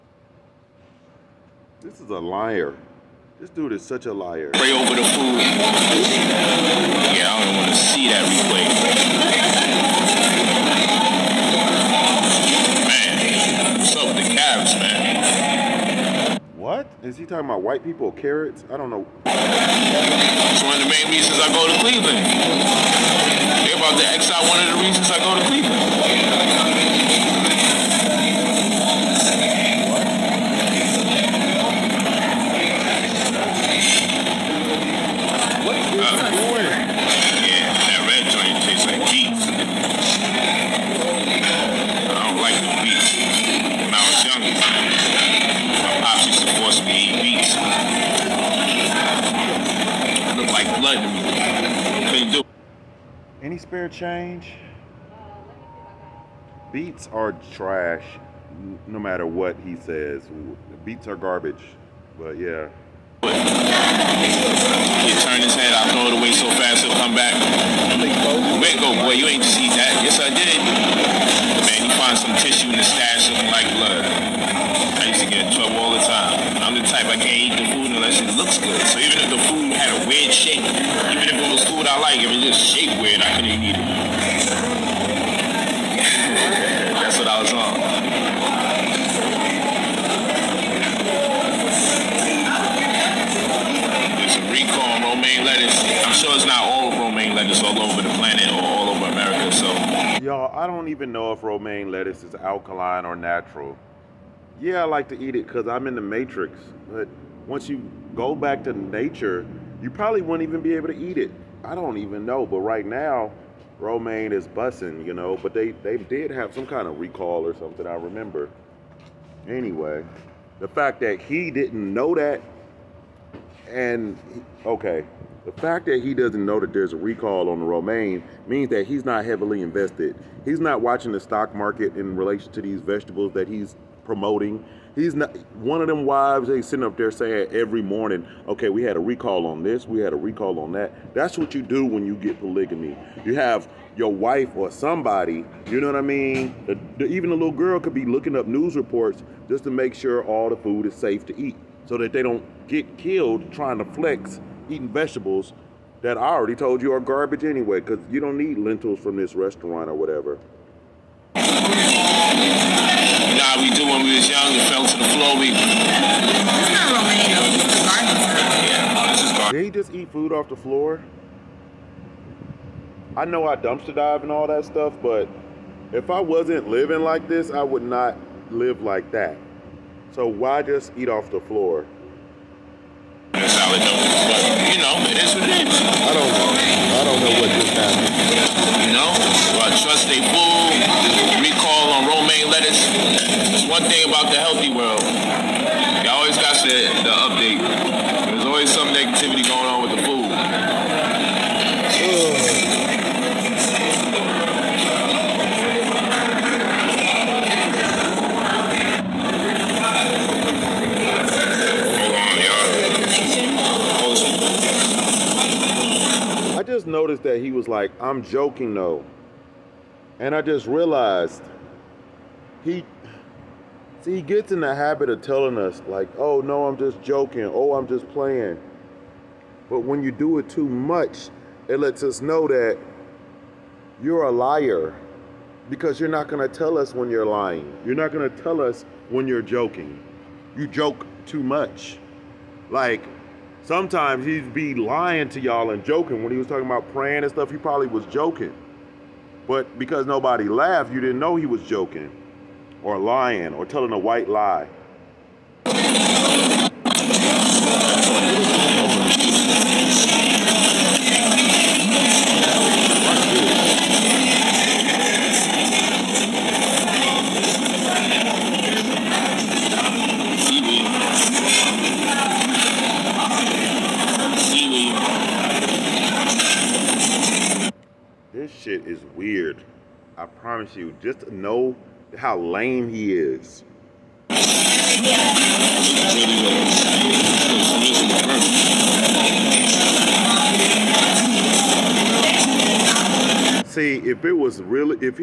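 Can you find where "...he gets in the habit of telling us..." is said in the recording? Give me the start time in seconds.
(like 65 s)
224 s.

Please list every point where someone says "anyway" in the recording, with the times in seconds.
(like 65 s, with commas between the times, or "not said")
119 s, 157 s.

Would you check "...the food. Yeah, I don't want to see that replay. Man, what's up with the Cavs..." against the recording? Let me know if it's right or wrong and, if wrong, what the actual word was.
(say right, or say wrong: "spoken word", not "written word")
right.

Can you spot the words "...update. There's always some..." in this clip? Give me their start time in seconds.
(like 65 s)
197 s.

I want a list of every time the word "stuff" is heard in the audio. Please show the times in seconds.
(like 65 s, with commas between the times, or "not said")
174 s, 247 s.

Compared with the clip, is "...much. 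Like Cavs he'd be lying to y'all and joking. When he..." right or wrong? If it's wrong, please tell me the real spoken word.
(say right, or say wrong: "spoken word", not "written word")
wrong: "Sometimes", not "Cavs".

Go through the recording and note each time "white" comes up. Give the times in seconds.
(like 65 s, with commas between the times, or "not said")
17 s, 253 s.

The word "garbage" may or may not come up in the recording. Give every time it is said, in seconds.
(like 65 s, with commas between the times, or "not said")
61 s, 156 s.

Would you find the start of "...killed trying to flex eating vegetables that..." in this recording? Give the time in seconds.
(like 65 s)
152 s.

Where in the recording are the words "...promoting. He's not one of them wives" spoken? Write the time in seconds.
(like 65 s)
134 s.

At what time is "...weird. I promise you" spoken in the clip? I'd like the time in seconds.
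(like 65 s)
279 s.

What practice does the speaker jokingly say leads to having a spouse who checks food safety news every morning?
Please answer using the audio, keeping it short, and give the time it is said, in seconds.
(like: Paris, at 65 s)
polygamy, at 142 s.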